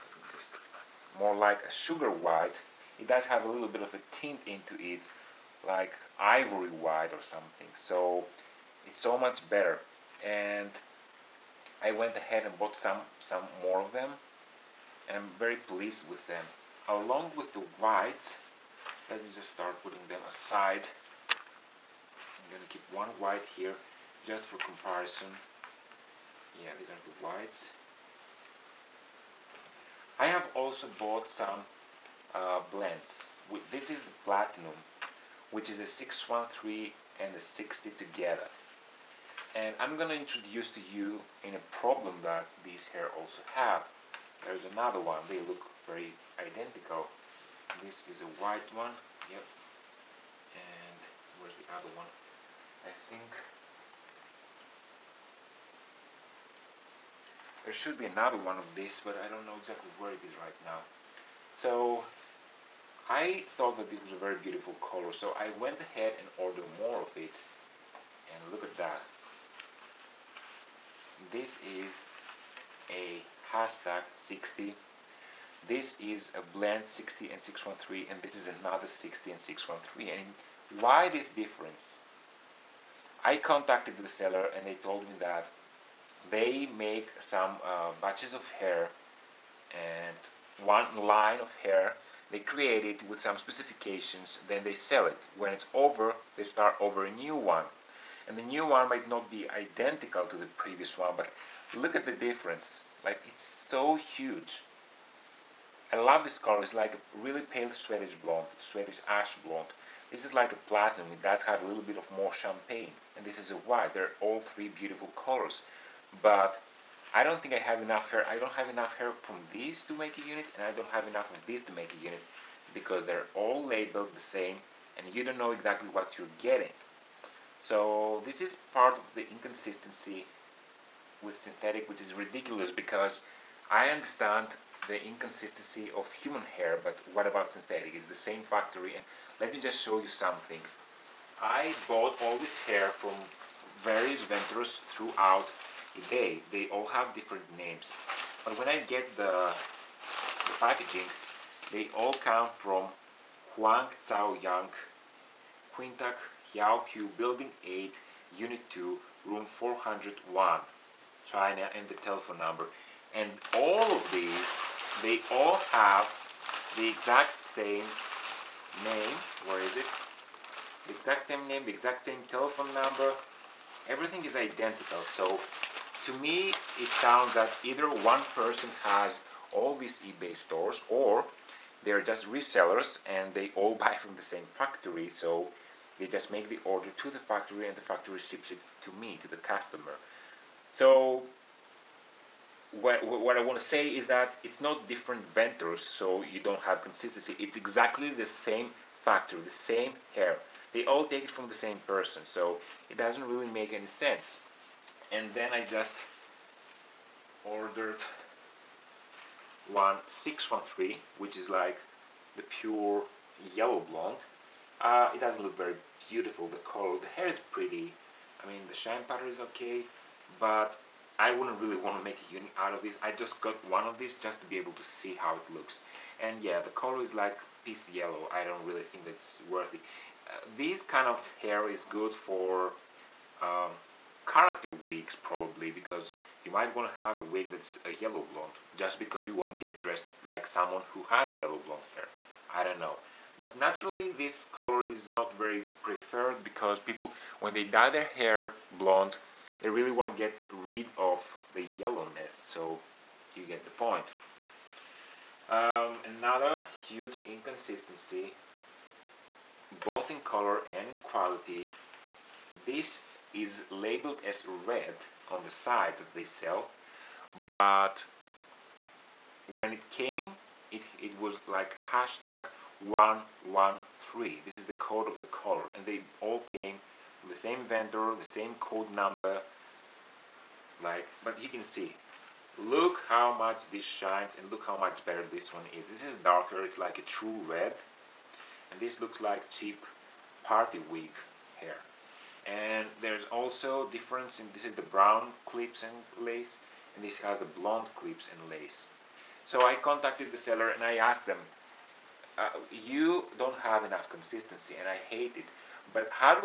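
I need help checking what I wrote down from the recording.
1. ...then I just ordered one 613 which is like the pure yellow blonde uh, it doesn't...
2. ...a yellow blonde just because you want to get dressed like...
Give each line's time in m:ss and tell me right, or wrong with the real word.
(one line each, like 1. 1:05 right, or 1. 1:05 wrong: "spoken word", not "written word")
1. 3:25 right
2. 3:57 right.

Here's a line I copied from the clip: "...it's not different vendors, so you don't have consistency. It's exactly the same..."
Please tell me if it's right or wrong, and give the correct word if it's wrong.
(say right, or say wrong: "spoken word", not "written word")
right.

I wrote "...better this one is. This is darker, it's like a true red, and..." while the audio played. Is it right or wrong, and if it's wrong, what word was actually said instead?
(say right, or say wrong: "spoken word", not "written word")
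right.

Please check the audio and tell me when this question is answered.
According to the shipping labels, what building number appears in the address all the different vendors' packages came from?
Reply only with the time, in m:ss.
2:37.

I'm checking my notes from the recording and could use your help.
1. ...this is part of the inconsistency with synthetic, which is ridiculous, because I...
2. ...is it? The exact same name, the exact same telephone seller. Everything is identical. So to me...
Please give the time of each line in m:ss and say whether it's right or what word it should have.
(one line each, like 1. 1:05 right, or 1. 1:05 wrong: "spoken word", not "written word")
1. 2:08 right
2. 2:49 wrong: "number", not "seller".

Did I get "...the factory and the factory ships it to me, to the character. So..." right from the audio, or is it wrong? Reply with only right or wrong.
wrong.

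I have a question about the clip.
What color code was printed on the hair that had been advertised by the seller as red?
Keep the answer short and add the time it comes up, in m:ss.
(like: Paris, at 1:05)
113, at 4:32.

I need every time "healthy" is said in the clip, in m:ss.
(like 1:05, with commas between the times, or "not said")
not said.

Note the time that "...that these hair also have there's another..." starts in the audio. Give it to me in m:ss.
0:42.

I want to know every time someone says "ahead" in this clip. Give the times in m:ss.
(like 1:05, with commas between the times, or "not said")
0:12, 1:05.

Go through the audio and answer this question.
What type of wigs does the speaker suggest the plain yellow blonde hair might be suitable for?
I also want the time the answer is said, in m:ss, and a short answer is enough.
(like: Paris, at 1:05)
character wigs, at 3:54.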